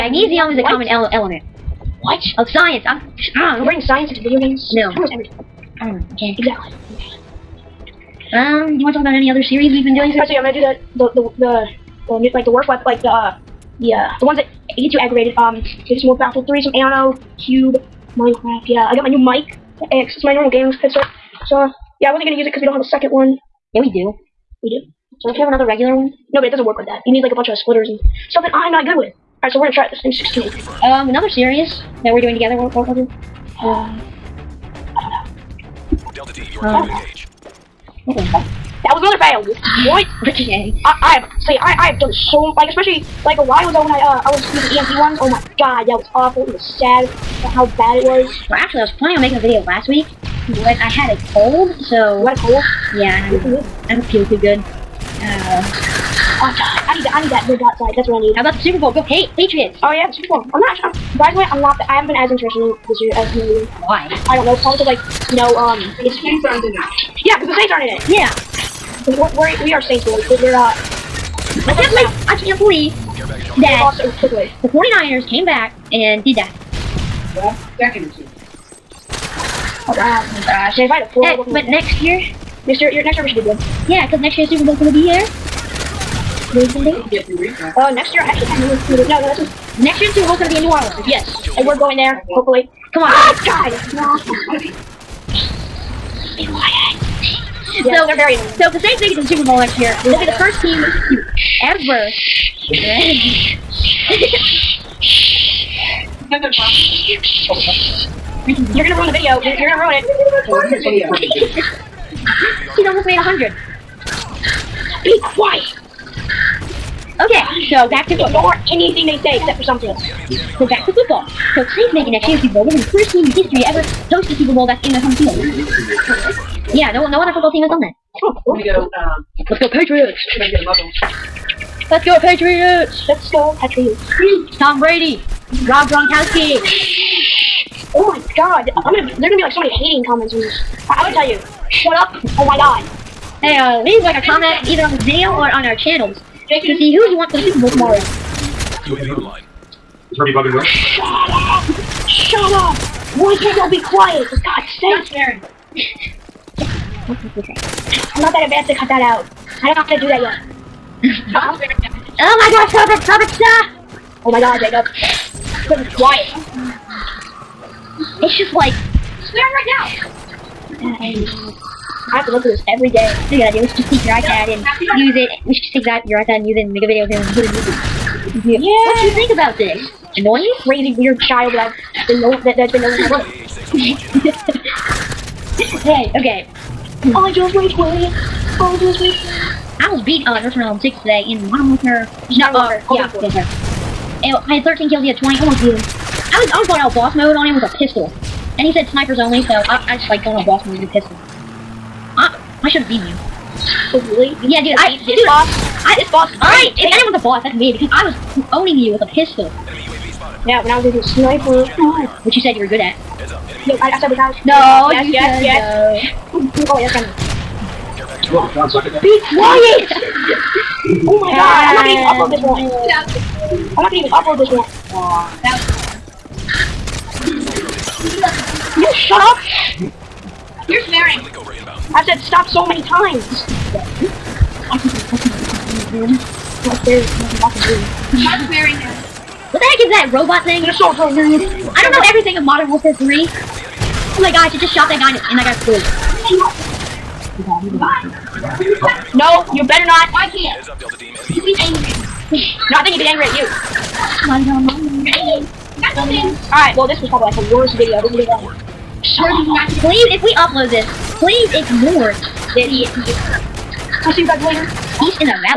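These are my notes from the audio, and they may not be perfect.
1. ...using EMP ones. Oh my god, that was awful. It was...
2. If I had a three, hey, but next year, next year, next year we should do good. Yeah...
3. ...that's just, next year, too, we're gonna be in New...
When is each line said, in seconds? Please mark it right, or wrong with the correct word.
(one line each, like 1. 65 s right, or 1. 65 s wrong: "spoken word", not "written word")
1. 44 s right
2. 80 s wrong: "four", not "three"
3. 89 s right.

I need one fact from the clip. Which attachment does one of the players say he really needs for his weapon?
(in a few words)
red dot sight.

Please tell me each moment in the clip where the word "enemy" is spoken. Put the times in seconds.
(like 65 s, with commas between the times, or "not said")
213 s, 251 s.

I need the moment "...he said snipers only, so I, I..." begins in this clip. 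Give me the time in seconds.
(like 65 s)
198 s.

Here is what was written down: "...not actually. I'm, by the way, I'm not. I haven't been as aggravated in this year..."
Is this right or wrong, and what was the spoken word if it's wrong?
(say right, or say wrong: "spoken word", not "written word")
wrong: "interested", not "aggravated".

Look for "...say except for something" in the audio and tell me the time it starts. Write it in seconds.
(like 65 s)
119 s.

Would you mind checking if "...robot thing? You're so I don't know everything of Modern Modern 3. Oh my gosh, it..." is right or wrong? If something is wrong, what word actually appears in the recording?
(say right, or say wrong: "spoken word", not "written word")
wrong: "Warfare", not "Modern".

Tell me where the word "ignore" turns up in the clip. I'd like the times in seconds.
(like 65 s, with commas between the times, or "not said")
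118 s, 261 s.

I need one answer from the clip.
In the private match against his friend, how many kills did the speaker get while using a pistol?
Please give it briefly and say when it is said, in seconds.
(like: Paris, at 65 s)
13, at 194 s.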